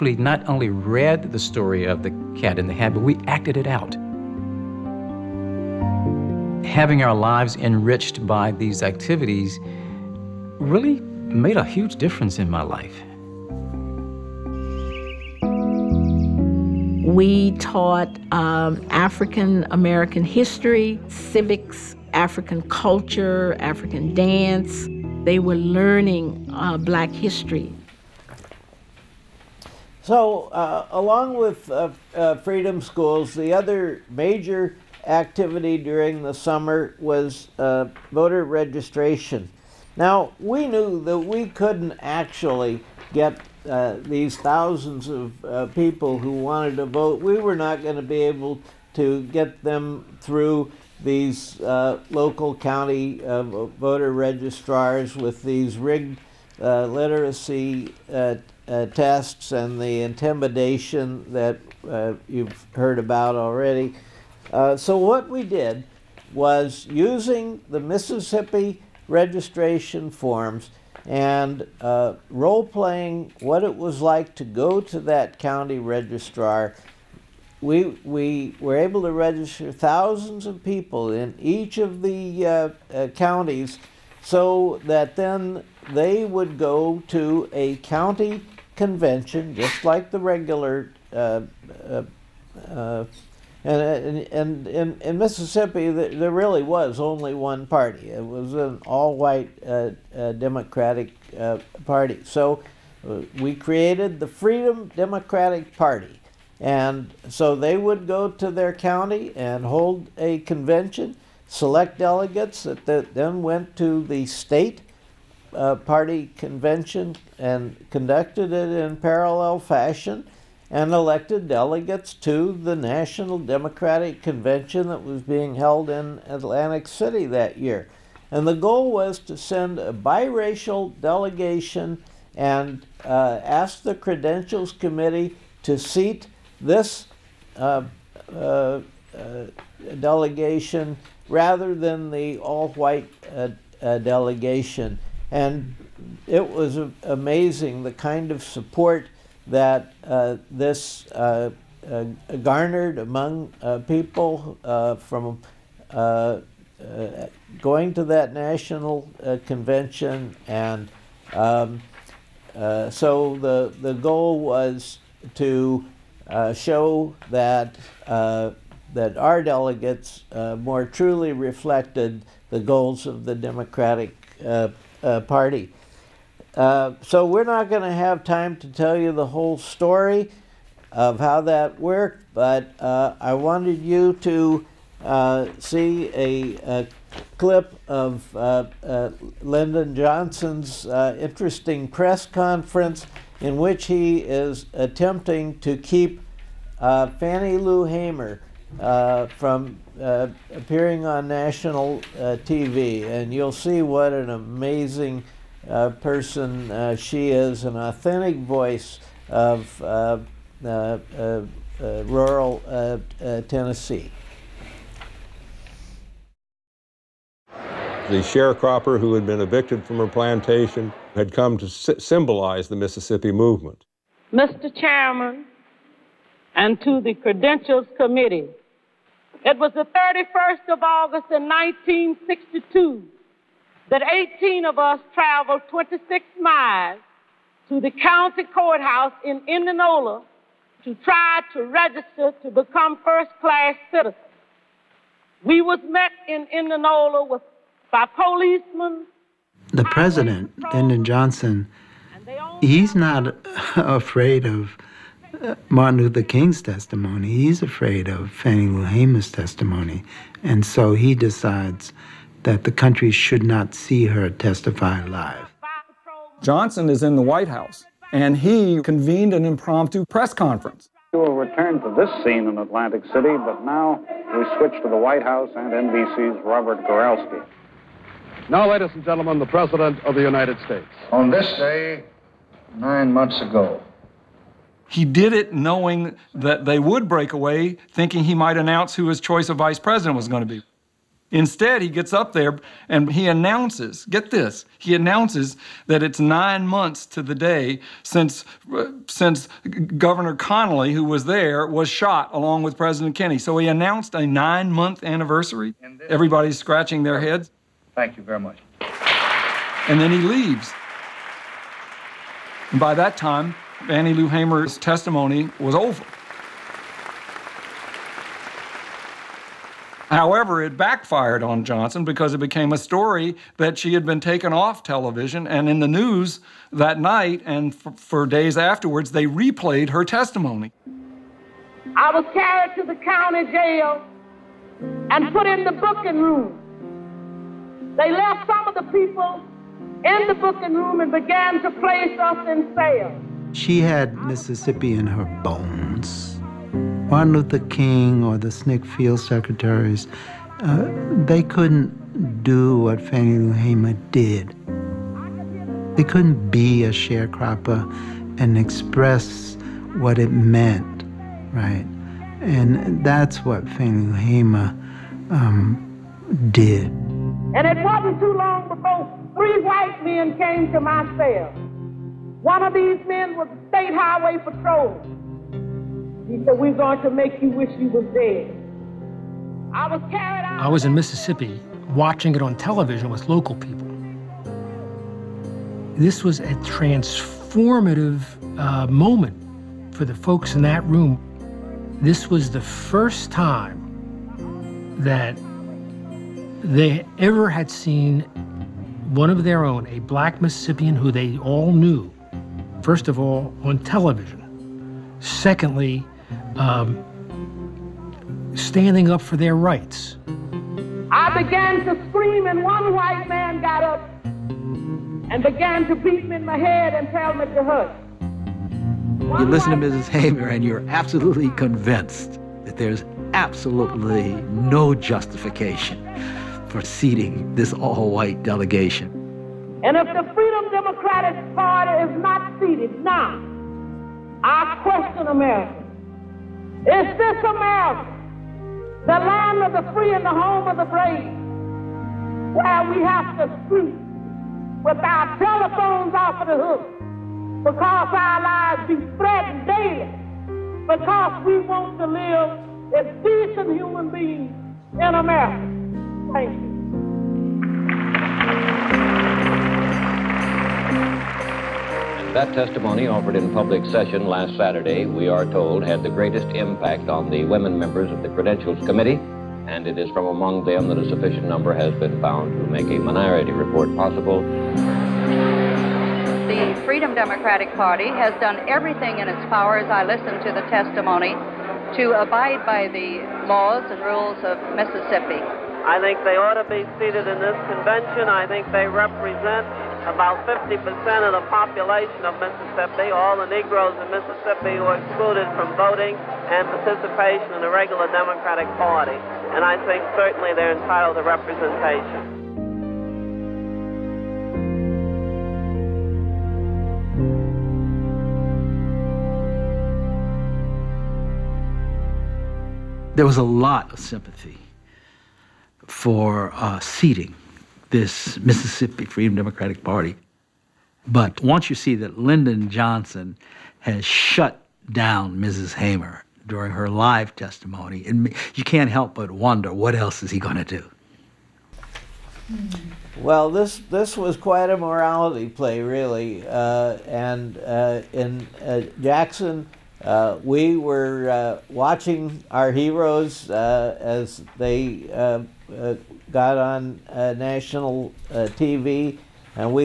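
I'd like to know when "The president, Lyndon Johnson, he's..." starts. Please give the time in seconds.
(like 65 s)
249 s.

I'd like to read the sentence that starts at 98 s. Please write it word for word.
It was an all white uh, uh, Democratic uh, Party.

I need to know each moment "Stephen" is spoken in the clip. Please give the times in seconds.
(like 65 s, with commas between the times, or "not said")
not said.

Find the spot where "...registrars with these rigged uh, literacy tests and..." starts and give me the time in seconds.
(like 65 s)
54 s.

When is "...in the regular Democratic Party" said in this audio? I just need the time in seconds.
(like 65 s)
497 s.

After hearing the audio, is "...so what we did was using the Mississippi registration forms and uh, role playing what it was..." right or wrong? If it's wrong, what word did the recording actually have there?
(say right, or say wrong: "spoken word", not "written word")
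right.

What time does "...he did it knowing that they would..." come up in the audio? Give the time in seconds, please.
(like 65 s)
284 s.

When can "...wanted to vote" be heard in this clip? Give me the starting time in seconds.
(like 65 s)
46 s.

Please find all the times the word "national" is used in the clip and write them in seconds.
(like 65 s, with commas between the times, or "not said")
122 s, 158 s, 201 s, 547 s.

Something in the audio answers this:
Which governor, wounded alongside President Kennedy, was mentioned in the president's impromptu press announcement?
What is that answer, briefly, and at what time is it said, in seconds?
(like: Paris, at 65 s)
Governor Connolly, at 299 s.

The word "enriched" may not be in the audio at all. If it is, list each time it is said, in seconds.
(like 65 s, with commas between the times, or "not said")
7 s.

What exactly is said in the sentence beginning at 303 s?
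So he announced a nine month anniversary.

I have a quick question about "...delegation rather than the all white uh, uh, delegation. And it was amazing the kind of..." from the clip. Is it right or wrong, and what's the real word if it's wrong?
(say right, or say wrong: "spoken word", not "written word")
right.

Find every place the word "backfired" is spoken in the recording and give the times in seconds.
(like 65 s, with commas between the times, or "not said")
320 s.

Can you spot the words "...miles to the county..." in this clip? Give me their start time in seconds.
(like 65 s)
236 s.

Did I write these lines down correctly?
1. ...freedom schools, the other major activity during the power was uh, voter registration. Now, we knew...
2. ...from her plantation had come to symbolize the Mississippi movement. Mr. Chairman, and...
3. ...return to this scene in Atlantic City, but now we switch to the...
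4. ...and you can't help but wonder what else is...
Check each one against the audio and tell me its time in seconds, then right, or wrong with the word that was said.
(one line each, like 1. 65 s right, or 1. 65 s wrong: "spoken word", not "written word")
1. 32 s wrong: "summer", not "power"
2. 219 s right
3. 271 s right
4. 528 s right.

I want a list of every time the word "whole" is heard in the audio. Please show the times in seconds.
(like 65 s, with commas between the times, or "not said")
179 s.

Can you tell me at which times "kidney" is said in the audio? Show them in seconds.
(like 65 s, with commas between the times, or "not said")
not said.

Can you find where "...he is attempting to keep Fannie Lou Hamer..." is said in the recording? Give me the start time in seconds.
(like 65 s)
193 s.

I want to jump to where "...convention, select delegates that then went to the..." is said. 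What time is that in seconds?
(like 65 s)
110 s.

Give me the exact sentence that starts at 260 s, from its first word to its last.
And so he decides that the country should not see her testify live.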